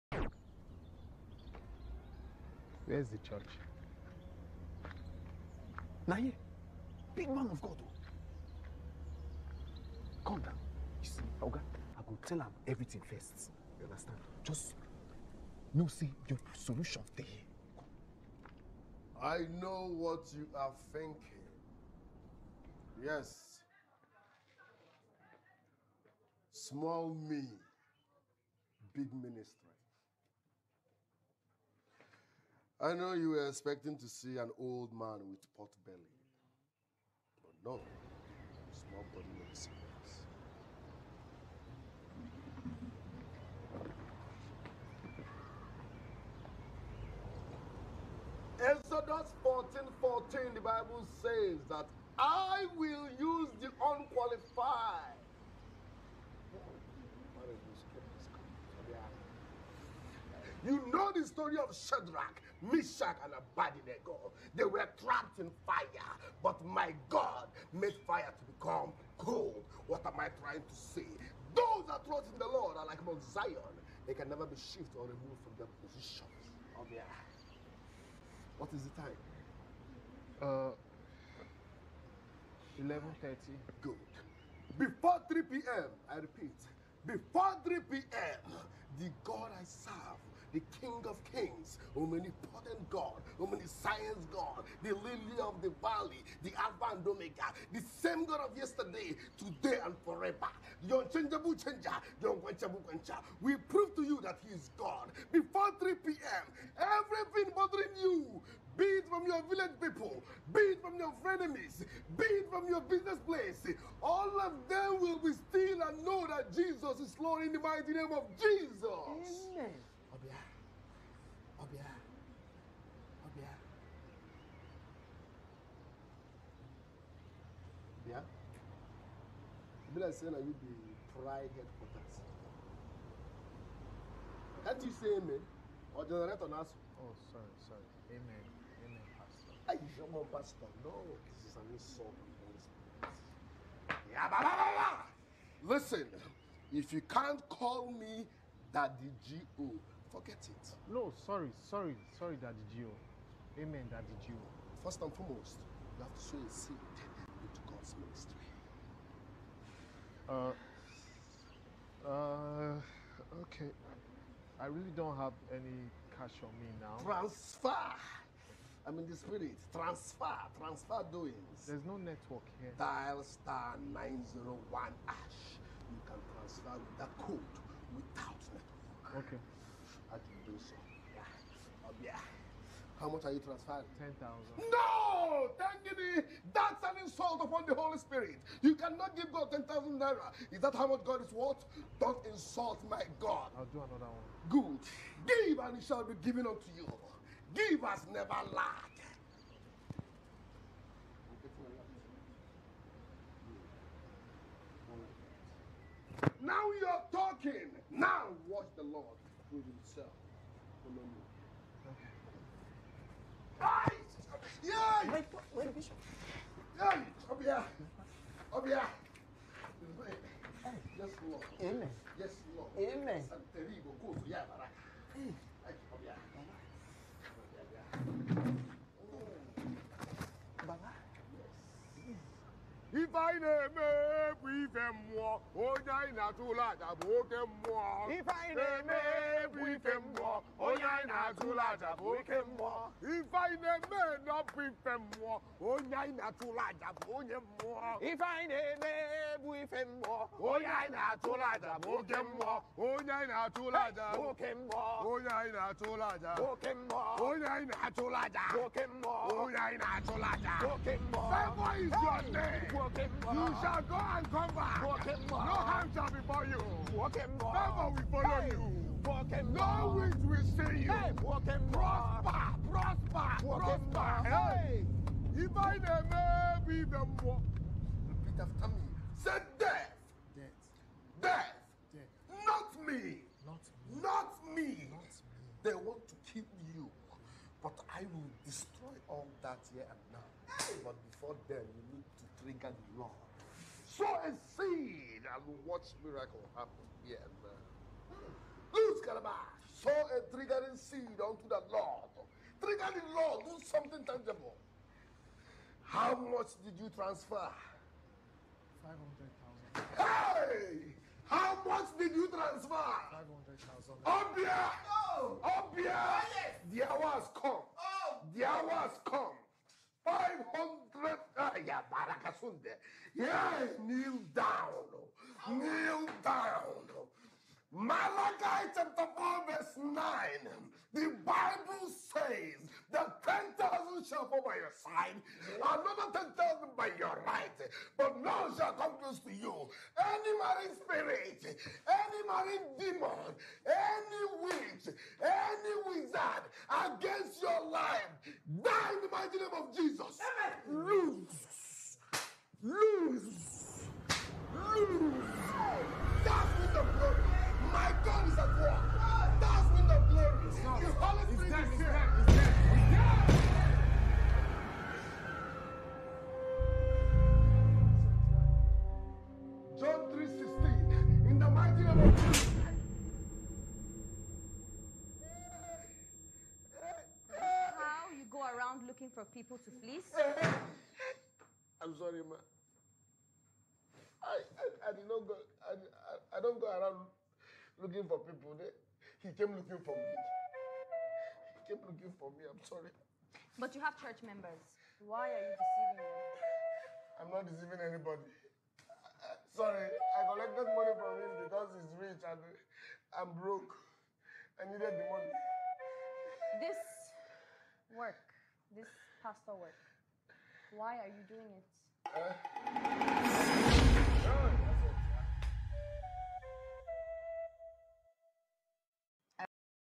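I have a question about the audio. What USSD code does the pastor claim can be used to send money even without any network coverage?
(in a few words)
*901#.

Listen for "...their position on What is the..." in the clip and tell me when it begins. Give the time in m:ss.
1:15.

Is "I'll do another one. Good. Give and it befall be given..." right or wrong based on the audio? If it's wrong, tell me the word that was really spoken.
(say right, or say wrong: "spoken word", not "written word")
wrong: "shall", not "befall".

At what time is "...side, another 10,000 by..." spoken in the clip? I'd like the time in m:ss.
5:34.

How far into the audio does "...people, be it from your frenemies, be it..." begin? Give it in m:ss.
1:49.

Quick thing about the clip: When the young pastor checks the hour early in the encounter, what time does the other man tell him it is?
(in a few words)
11.30.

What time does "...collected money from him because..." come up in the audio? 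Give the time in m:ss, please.
6:40.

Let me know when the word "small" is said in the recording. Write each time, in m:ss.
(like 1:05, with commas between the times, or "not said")
0:26, 0:38.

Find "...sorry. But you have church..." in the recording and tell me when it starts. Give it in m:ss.
6:32.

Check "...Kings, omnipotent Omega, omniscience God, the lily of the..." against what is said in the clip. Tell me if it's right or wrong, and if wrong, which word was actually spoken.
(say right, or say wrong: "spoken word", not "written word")
wrong: "God", not "Omega".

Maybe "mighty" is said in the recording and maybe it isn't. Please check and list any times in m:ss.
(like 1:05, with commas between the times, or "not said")
1:57, 5:49, 6:11.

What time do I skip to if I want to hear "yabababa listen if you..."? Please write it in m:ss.
2:24.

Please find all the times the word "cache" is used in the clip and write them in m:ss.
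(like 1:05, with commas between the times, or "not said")
not said.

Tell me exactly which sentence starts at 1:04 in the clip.
They were trapped in fire, but my God made fire to become cold.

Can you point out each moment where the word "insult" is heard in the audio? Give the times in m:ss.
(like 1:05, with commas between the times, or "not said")
2:21, 3:07, 3:12.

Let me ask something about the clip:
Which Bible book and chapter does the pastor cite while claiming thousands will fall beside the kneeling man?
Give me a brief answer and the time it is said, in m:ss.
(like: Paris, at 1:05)
Malachi chapter 4, at 5:27.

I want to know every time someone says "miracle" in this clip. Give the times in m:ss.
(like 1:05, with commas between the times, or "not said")
4:56.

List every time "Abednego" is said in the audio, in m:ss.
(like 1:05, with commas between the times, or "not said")
1:03.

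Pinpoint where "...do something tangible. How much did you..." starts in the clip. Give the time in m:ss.
5:03.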